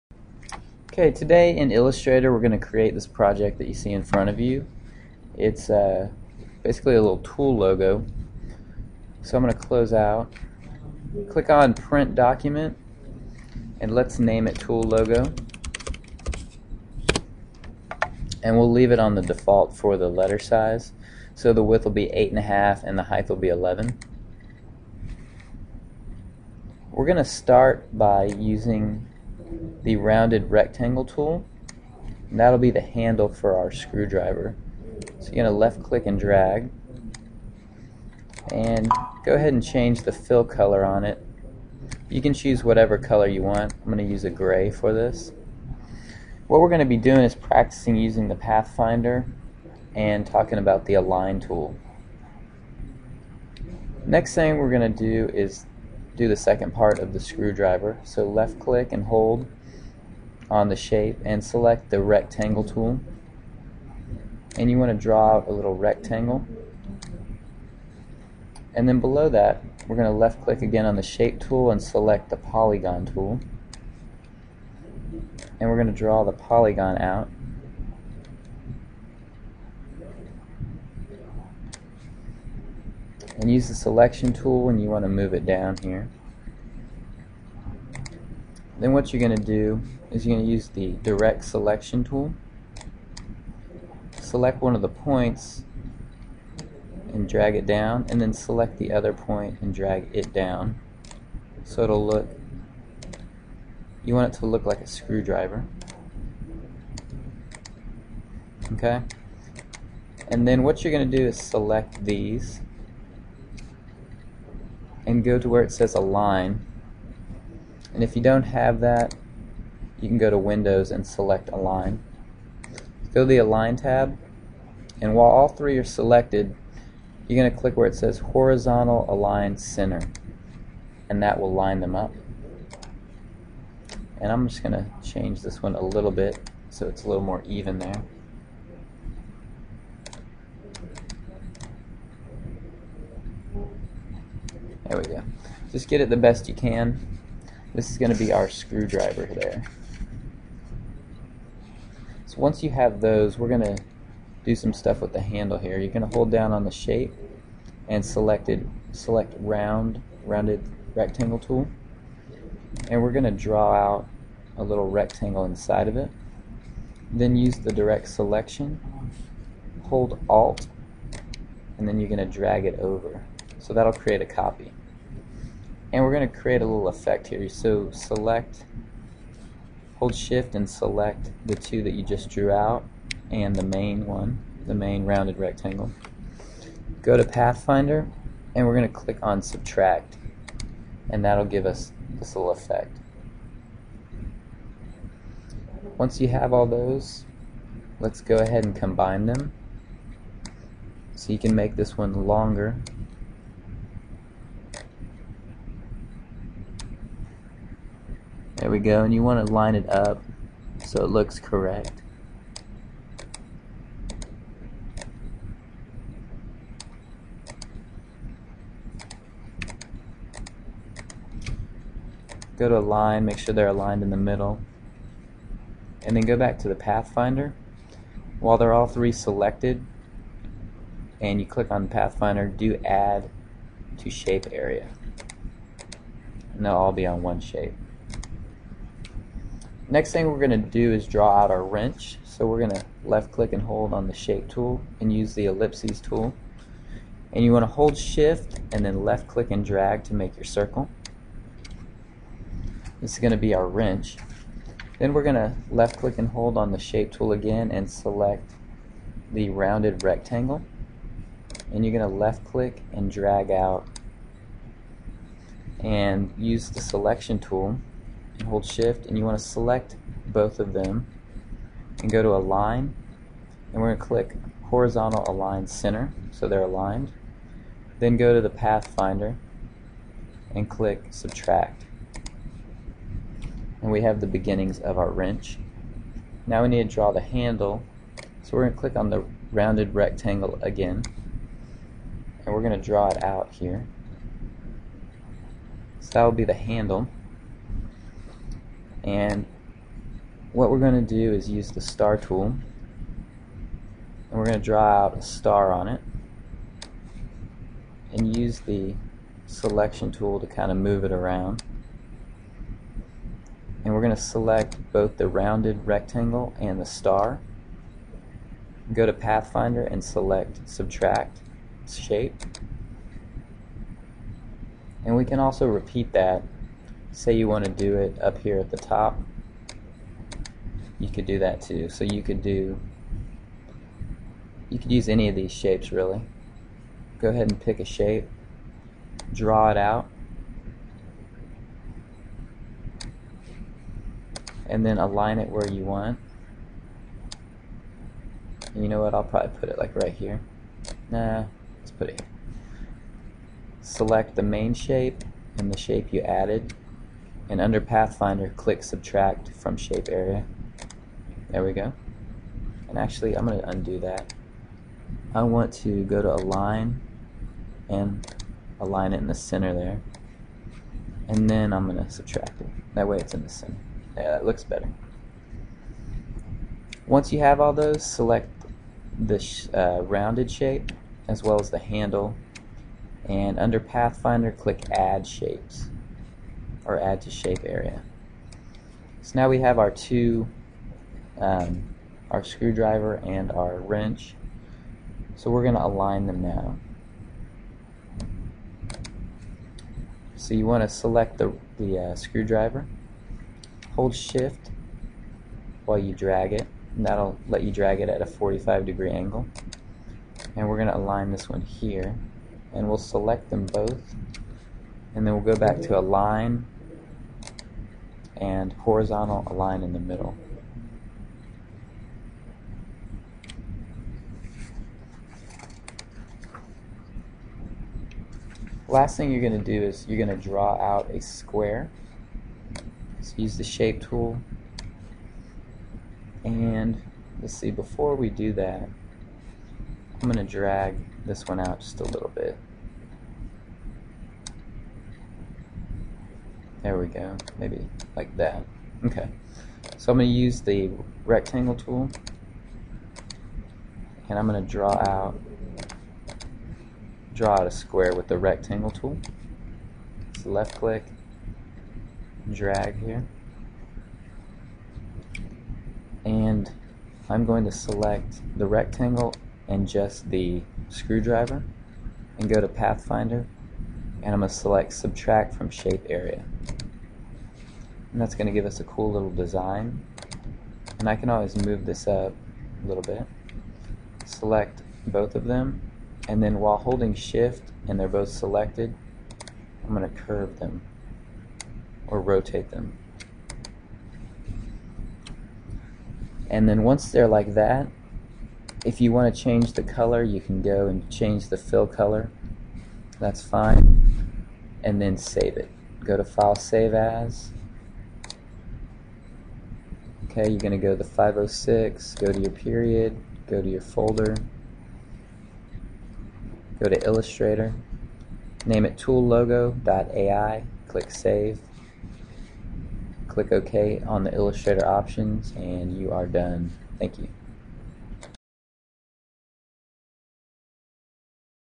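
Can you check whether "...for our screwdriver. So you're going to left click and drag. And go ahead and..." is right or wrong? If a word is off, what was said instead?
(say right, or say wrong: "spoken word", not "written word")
right.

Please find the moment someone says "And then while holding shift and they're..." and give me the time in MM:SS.
08:06.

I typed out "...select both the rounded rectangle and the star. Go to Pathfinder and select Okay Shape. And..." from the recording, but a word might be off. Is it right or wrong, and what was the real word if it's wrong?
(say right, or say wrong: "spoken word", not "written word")
wrong: "Subtract", not "Okay".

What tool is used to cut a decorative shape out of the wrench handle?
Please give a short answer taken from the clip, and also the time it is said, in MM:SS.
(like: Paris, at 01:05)
Star tool, at 05:01.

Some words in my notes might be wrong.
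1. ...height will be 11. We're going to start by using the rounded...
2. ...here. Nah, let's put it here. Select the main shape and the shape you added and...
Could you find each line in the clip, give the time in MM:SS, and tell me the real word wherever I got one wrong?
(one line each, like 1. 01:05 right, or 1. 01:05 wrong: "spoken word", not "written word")
1. 00:23 right
2. 05:50 right.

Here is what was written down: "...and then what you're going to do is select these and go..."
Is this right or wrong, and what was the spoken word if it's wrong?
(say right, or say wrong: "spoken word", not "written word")
right.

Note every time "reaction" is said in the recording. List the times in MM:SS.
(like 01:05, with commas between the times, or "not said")
not said.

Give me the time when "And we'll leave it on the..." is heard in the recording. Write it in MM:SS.
00:18.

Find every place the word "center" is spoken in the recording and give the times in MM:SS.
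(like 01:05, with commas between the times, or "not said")
02:09, 04:35, 06:09, 06:13.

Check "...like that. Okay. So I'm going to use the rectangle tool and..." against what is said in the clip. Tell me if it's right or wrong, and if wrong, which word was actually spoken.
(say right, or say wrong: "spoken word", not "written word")
right.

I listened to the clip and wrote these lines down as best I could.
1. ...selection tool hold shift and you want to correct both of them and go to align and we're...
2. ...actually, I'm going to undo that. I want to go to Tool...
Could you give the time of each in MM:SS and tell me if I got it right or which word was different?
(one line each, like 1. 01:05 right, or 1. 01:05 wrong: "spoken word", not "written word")
1. 04:26 wrong: "select", not "correct"
2. 06:02 wrong: "Align", not "Tool".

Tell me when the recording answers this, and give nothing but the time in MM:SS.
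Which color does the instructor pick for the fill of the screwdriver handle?
00:44.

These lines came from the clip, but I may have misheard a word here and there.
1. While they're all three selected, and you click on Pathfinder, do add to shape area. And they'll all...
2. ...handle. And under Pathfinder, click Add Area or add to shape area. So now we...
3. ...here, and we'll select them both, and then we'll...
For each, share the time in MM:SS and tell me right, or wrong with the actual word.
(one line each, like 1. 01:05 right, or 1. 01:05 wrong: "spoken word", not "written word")
1. 03:48 right
2. 06:21 wrong: "Shapes", not "Area"
3. 06:51 right.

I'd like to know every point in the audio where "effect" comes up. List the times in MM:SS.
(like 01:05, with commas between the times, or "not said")
02:56, 03:12.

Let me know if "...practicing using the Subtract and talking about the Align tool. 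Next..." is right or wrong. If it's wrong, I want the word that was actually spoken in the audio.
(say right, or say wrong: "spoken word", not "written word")
wrong: "Pathfinder", not "Subtract".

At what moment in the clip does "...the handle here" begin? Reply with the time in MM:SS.
02:35.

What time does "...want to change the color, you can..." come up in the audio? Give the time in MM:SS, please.
08:19.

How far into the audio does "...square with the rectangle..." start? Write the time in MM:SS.
07:37.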